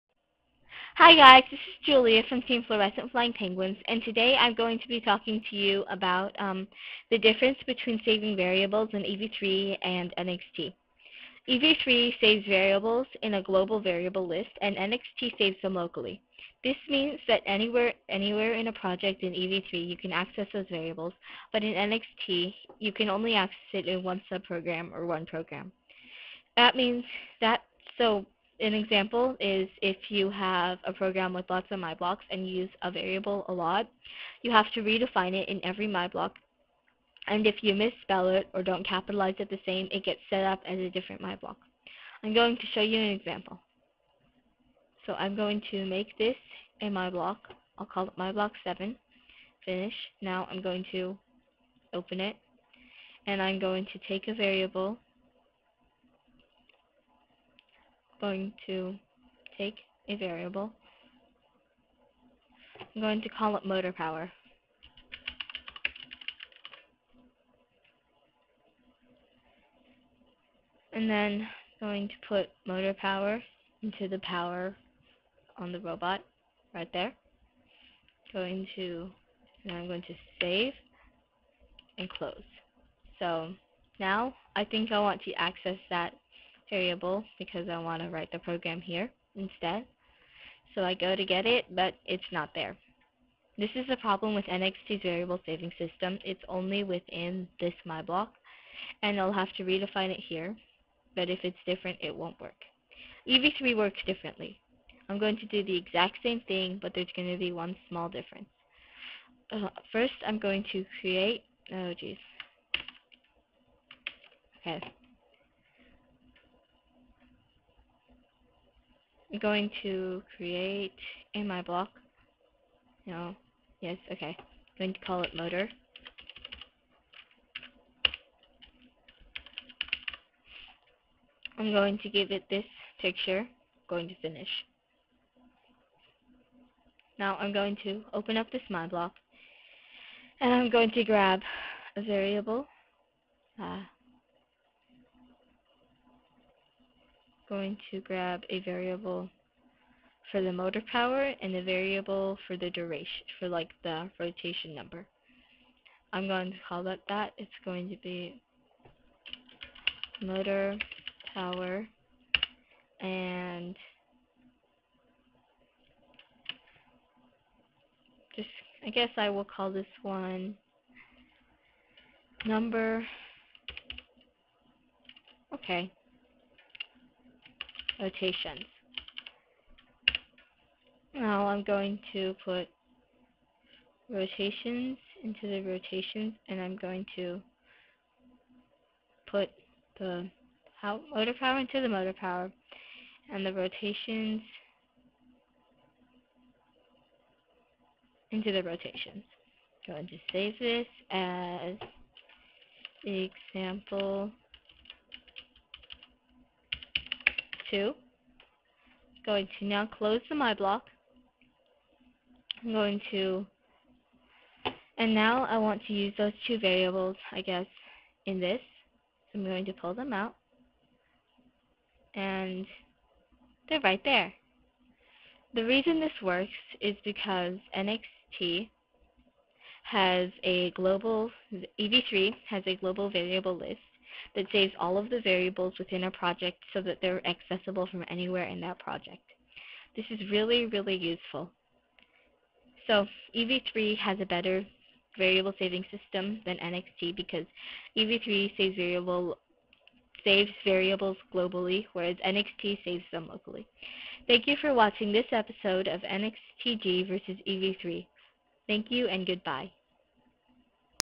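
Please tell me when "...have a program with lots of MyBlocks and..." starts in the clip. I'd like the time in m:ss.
0:30.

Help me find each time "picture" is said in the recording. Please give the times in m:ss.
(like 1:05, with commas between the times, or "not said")
2:13.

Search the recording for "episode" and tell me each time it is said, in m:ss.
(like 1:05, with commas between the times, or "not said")
4:15.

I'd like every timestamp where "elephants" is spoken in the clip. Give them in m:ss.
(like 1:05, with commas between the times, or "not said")
not said.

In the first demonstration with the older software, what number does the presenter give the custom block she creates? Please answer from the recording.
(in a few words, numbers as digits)
7.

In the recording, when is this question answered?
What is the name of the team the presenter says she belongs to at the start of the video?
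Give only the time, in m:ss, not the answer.
0:02.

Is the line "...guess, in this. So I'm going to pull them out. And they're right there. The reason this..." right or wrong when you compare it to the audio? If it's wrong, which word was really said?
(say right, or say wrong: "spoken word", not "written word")
right.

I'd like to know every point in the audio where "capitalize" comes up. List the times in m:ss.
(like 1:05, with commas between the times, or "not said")
0:38.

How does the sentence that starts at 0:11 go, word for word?
EV3 saves variables in a global variable list, and NXT saves them locally.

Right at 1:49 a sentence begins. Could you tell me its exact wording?
Uh, first, I'm going to create, oh geez.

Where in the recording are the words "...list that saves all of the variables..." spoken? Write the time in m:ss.
3:53.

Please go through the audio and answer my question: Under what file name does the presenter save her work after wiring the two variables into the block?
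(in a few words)
example 2.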